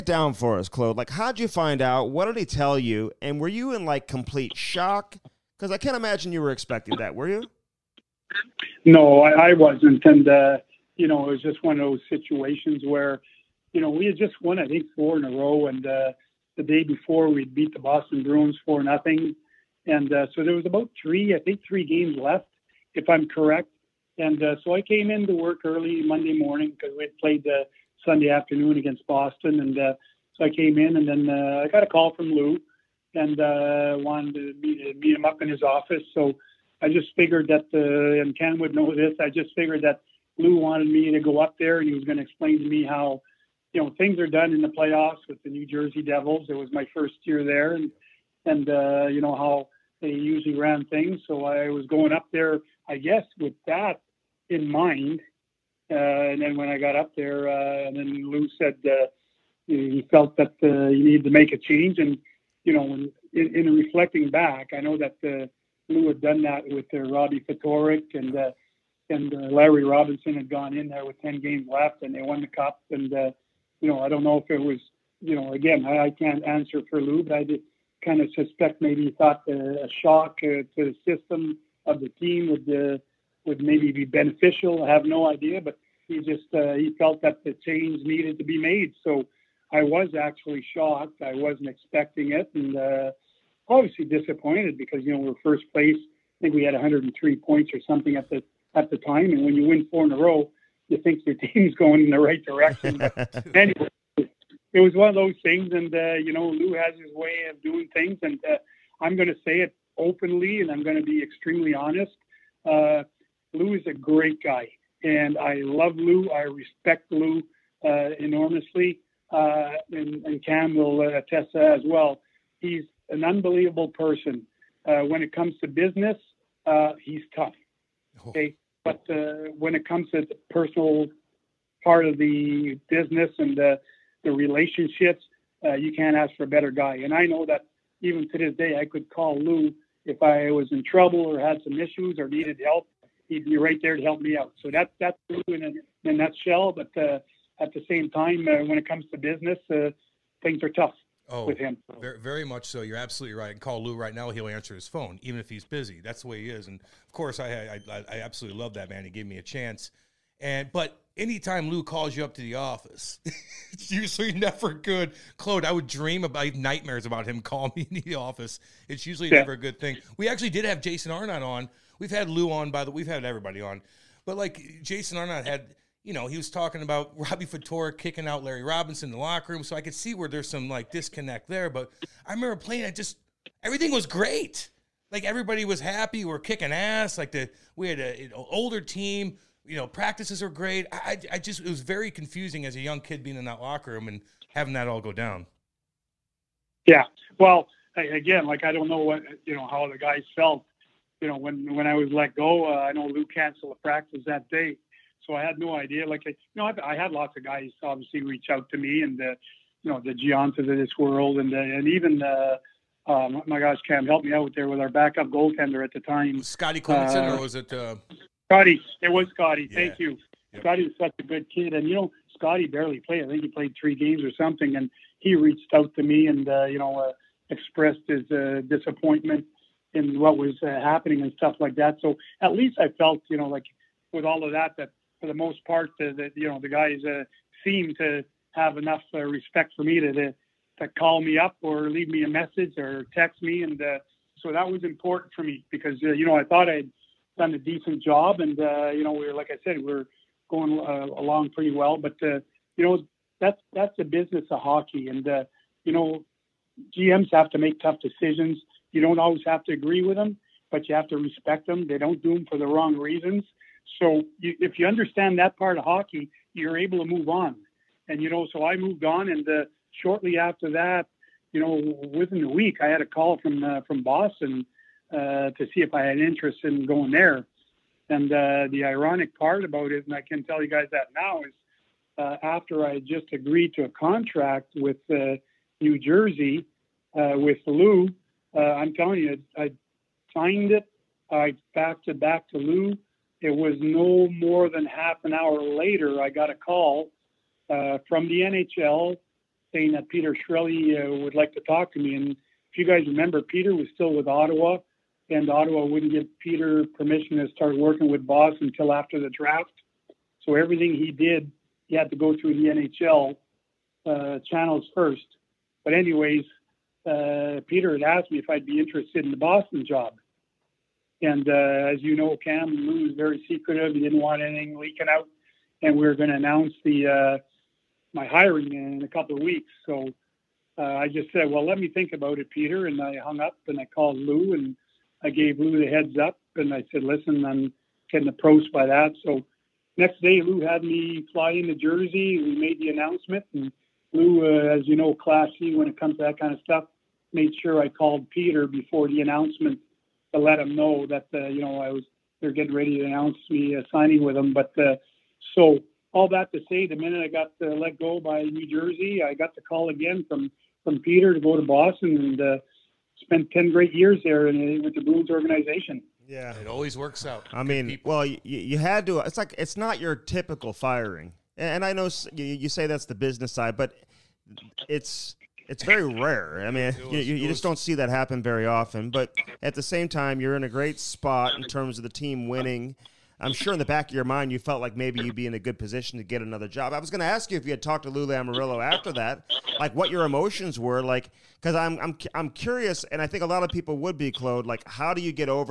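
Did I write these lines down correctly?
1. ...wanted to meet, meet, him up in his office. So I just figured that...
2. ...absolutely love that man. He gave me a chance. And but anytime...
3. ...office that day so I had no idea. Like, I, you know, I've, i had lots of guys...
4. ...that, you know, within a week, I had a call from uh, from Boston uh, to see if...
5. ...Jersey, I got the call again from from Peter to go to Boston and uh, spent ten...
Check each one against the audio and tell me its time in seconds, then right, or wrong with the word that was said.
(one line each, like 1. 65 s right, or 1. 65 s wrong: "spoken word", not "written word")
1. 33 s right
2. 158 s right
3. 203 s wrong: "practice", not "office"
4. 270 s right
5. 358 s right.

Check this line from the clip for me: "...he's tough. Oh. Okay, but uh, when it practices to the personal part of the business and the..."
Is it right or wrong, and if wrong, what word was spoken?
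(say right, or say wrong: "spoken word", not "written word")
wrong: "comes", not "practices".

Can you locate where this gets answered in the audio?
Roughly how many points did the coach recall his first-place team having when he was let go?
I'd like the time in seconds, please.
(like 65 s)
96 s.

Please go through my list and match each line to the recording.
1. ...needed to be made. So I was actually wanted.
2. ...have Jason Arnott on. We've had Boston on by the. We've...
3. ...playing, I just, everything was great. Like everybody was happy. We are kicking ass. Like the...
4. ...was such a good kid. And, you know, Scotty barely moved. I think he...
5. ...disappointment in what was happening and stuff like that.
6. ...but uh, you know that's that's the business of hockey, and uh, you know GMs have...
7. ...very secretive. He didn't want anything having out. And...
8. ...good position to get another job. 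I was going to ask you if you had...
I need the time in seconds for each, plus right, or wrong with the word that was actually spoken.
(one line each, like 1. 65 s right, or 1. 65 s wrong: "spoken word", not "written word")
1. 88 s wrong: "shocked", not "wanted"
2. 170 s wrong: "Lou", not "Boston"
3. 182 s right
4. 220 s wrong: "played", not "moved"
5. 228 s right
6. 251 s right
7. 323 s wrong: "leaking", not "having"
8. 385 s right.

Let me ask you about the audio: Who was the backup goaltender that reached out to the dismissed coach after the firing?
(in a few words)
Scotty Clemmensen.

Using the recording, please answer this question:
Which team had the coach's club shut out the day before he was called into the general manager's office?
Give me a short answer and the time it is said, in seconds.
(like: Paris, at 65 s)
Boston Bruins, at 17 s.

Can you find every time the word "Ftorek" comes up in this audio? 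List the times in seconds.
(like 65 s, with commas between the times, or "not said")
67 s, 177 s.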